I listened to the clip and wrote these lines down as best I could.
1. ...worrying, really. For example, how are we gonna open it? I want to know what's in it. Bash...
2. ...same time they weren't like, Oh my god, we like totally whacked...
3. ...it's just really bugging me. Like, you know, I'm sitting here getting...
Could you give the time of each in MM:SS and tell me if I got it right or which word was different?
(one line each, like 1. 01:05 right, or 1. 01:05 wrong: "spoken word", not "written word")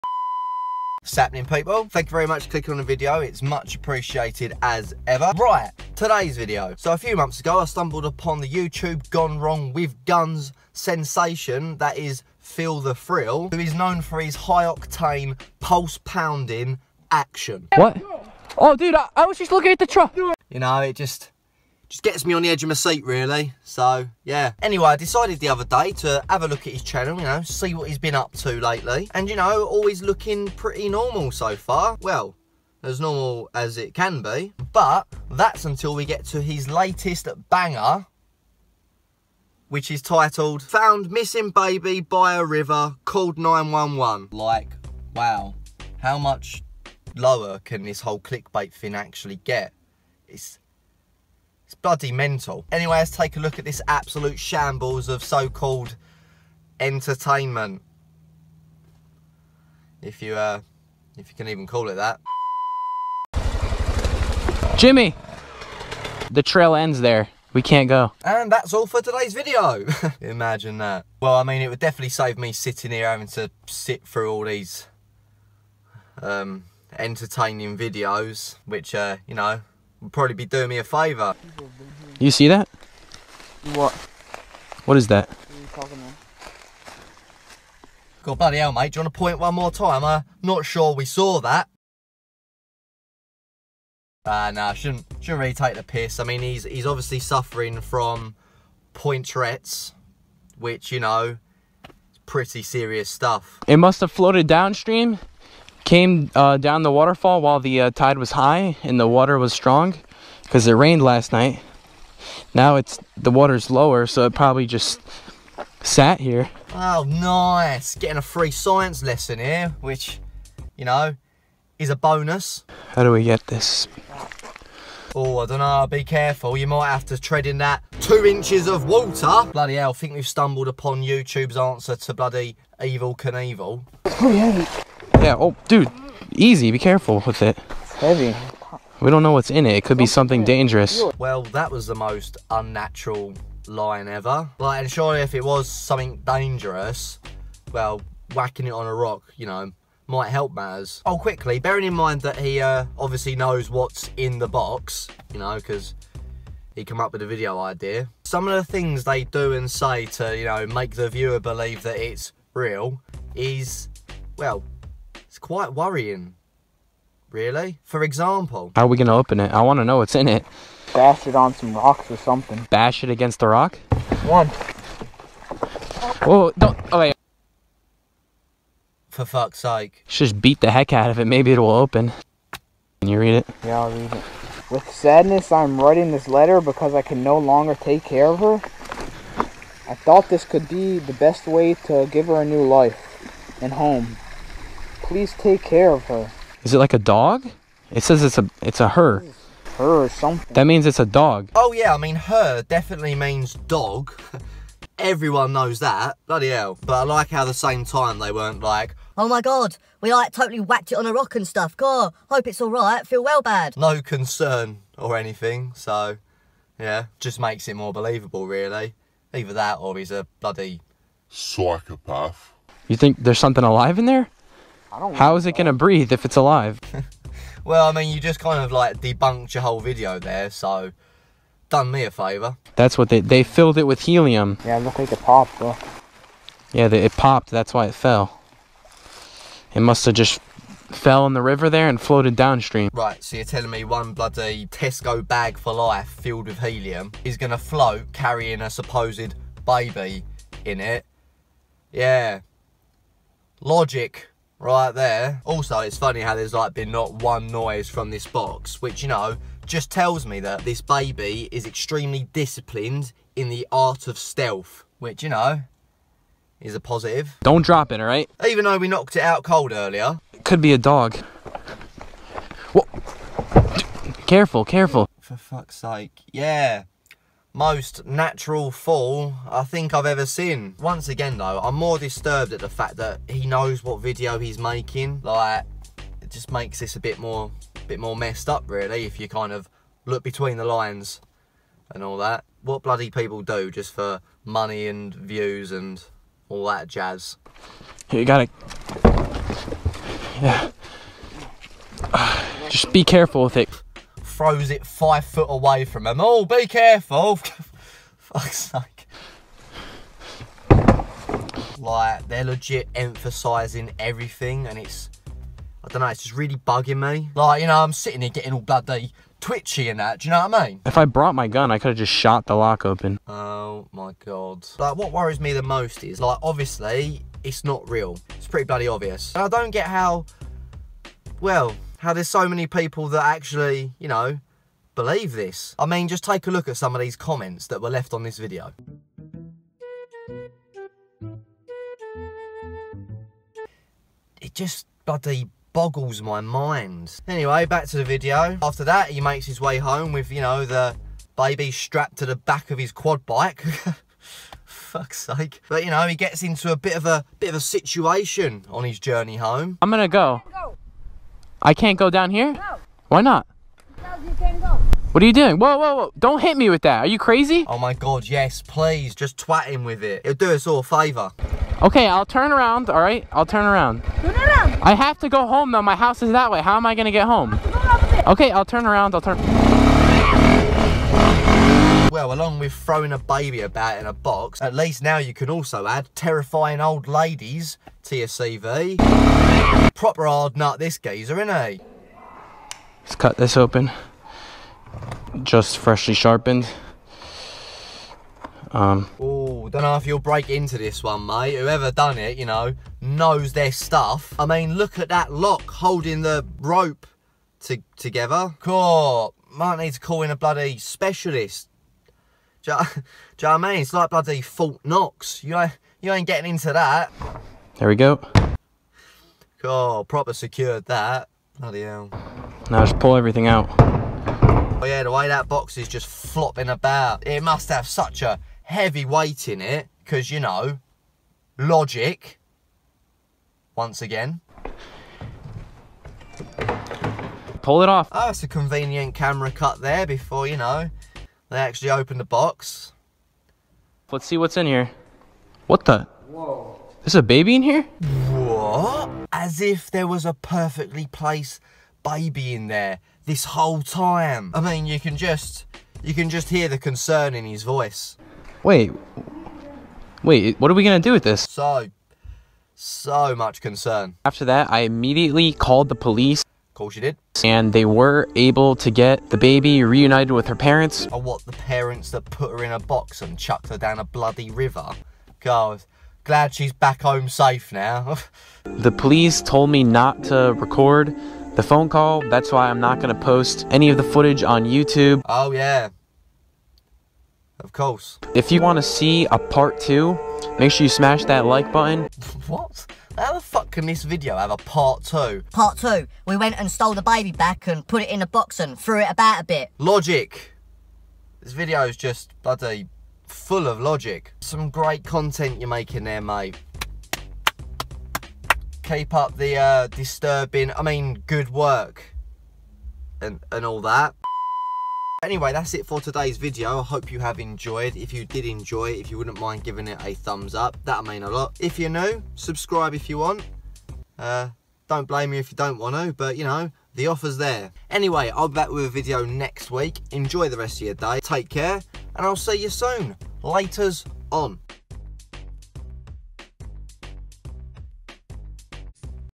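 1. 02:45 right
2. 03:27 right
3. 05:16 right.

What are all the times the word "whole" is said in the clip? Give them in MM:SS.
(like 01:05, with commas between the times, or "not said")
00:47, 03:49, 07:33.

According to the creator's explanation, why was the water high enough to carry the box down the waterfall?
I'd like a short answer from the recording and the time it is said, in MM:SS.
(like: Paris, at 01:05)
it rained last night, at 01:50.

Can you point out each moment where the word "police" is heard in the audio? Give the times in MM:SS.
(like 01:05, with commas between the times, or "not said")
07:45, 07:58.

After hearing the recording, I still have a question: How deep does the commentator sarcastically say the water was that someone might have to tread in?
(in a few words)
2 inches.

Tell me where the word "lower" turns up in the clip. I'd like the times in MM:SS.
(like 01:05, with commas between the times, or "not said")
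00:47, 01:53.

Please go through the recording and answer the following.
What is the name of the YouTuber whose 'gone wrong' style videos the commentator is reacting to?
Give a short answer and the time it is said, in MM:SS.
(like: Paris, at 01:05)
Phil the Thrill, at 00:12.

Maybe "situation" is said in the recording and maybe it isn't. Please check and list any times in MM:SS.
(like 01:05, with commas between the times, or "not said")
05:57.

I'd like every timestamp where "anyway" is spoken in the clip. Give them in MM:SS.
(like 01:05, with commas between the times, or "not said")
00:24, 00:52, 05:47, 08:35, 08:47.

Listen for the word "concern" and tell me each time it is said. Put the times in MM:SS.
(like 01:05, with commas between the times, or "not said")
03:34, 07:36, 07:43.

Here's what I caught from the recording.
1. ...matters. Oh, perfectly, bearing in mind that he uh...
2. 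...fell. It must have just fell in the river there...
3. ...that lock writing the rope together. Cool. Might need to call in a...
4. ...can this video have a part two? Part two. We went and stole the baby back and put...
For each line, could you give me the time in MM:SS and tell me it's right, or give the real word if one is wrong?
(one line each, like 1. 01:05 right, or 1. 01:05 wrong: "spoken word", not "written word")
1. 02:30 wrong: "quickly", not "perfectly"
2. 03:57 right
3. 06:45 wrong: "holding", not "writing"
4. 08:13 right.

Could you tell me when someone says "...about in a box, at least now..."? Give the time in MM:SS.
06:23.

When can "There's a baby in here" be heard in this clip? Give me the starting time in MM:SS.
07:27.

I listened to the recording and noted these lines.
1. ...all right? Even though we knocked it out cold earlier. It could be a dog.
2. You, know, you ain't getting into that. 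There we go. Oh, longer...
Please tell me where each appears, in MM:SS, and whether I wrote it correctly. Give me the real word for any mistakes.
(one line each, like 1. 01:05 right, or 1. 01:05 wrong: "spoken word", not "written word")
1. 04:27 right
2. 06:55 wrong: "proper", not "longer".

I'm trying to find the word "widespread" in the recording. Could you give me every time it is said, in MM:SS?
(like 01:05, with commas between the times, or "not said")
not said.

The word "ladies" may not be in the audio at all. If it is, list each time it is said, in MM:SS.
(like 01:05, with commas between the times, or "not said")
06:27.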